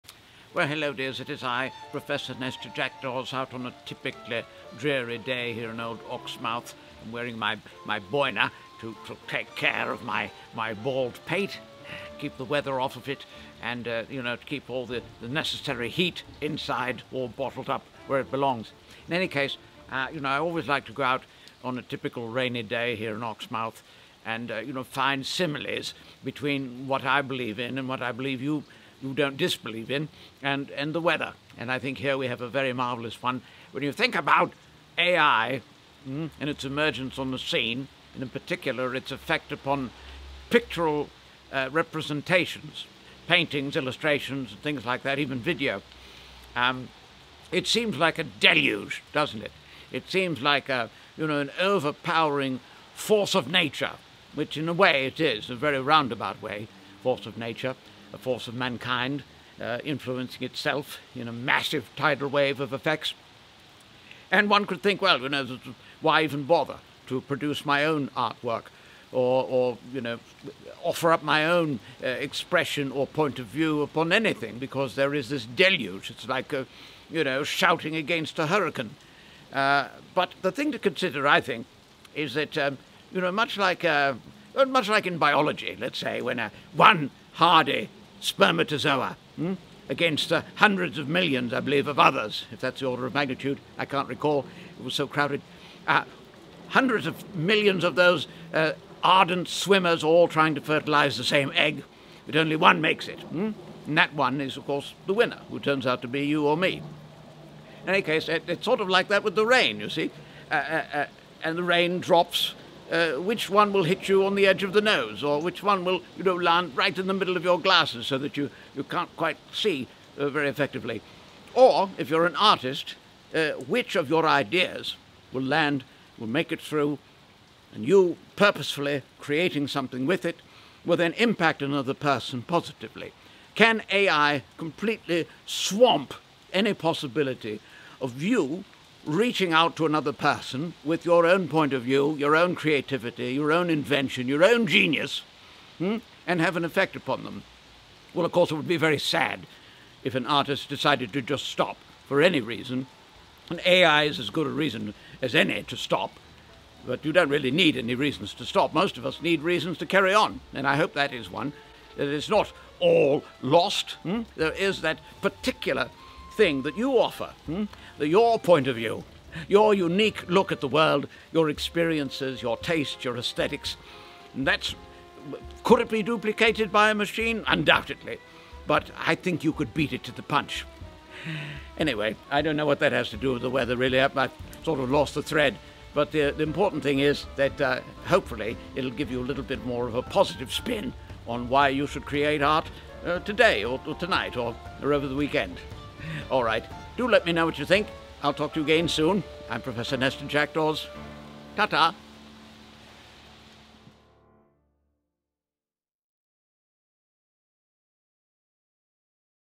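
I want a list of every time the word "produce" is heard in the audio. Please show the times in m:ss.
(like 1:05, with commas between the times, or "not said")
1:07.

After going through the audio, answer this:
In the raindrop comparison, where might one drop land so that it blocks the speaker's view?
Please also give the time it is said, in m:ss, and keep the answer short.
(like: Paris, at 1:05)
middle of your glasses, at 1:57.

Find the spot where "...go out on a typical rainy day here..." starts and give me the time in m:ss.
0:20.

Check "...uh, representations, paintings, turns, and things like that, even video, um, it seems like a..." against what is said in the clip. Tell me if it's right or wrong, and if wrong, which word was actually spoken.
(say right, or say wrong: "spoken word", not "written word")
wrong: "illustrations", not "turns".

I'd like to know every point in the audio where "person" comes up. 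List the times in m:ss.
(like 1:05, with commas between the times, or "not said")
2:11, 2:20.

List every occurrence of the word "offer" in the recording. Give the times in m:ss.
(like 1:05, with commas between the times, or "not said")
1:10, 2:46.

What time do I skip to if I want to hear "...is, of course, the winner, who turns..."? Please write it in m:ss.
1:44.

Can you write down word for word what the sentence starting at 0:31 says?
And I think here we have a very marvelous one.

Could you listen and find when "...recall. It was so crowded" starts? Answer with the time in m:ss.
1:34.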